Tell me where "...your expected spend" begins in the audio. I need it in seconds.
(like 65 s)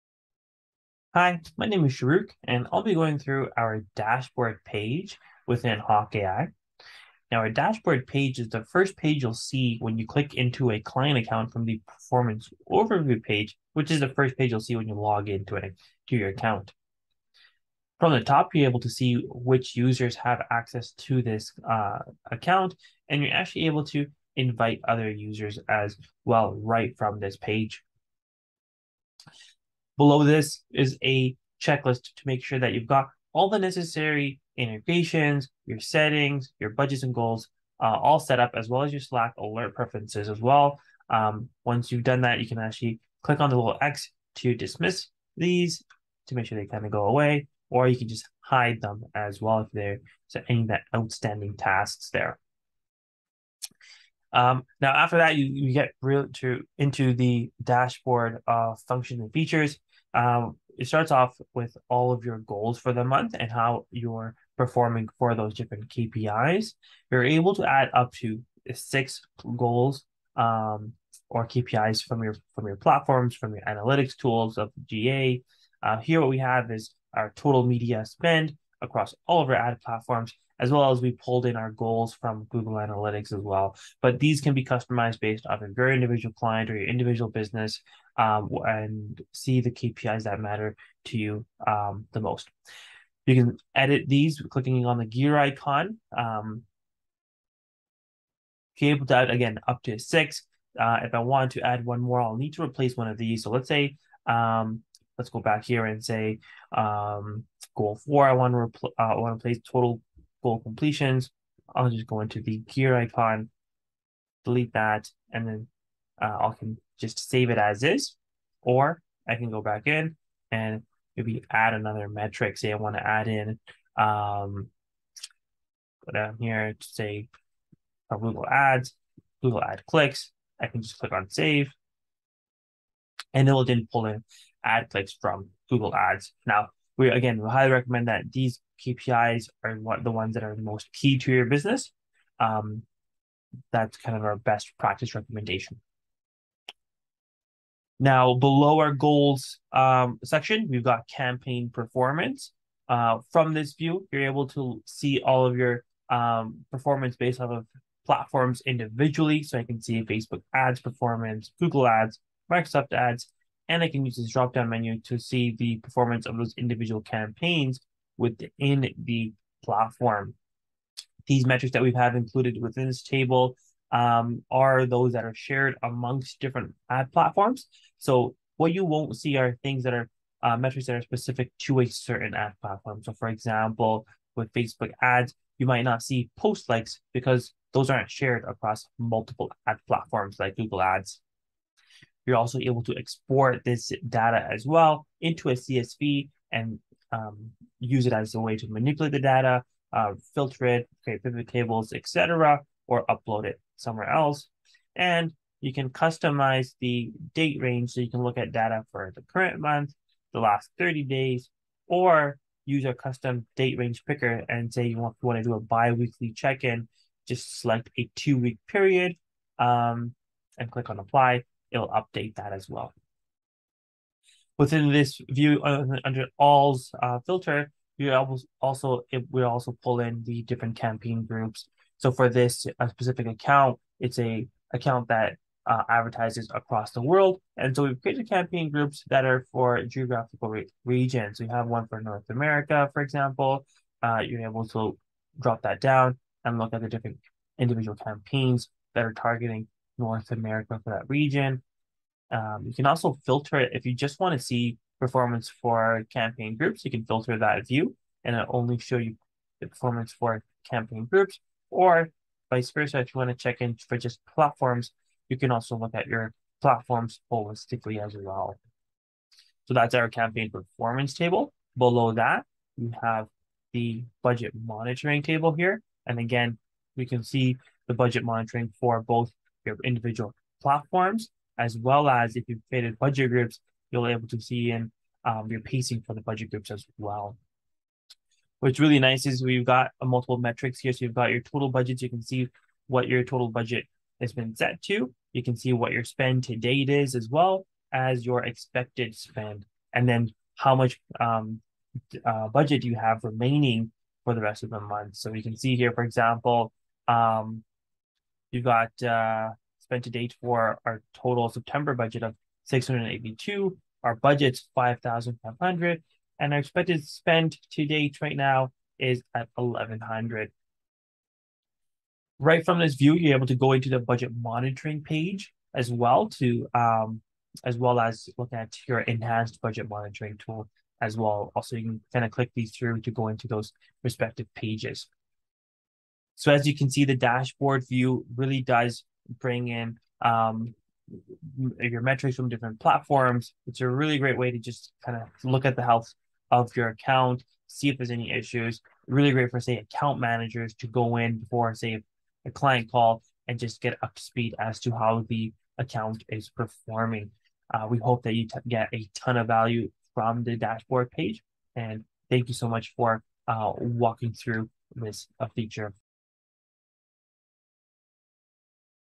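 298 s.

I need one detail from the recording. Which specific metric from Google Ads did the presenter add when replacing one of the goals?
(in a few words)
Google Ad clicks.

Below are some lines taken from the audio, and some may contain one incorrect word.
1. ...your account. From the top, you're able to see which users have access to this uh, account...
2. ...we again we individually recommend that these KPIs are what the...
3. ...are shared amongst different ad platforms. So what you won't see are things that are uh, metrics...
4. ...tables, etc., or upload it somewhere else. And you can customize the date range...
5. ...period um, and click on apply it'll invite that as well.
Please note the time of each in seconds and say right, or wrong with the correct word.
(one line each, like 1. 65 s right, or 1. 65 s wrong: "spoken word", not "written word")
1. 16 s right
2. 137 s wrong: "highly", not "individually"
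3. 175 s right
4. 201 s right
5. 218 s wrong: "update", not "invite".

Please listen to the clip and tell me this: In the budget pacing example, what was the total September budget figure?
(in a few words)
5,500.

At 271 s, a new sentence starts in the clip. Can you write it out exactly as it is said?
Below that, we have the budget monitoring table here.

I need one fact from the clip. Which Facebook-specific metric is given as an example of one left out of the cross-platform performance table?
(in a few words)
post likes.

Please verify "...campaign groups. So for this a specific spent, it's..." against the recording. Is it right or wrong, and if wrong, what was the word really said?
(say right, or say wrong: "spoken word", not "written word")
wrong: "account", not "spent".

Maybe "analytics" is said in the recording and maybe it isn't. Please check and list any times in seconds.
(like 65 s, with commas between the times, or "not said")
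73 s, 82 s.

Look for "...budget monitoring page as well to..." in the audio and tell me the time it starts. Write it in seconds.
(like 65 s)
323 s.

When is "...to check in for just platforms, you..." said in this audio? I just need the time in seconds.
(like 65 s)
263 s.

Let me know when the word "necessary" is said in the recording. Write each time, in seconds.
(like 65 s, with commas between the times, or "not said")
33 s.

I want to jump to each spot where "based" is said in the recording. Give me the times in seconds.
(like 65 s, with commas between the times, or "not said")
85 s, 157 s.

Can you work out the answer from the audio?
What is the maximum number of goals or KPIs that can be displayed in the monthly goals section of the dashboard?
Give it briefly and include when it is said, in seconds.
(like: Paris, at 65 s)
6, at 68 s.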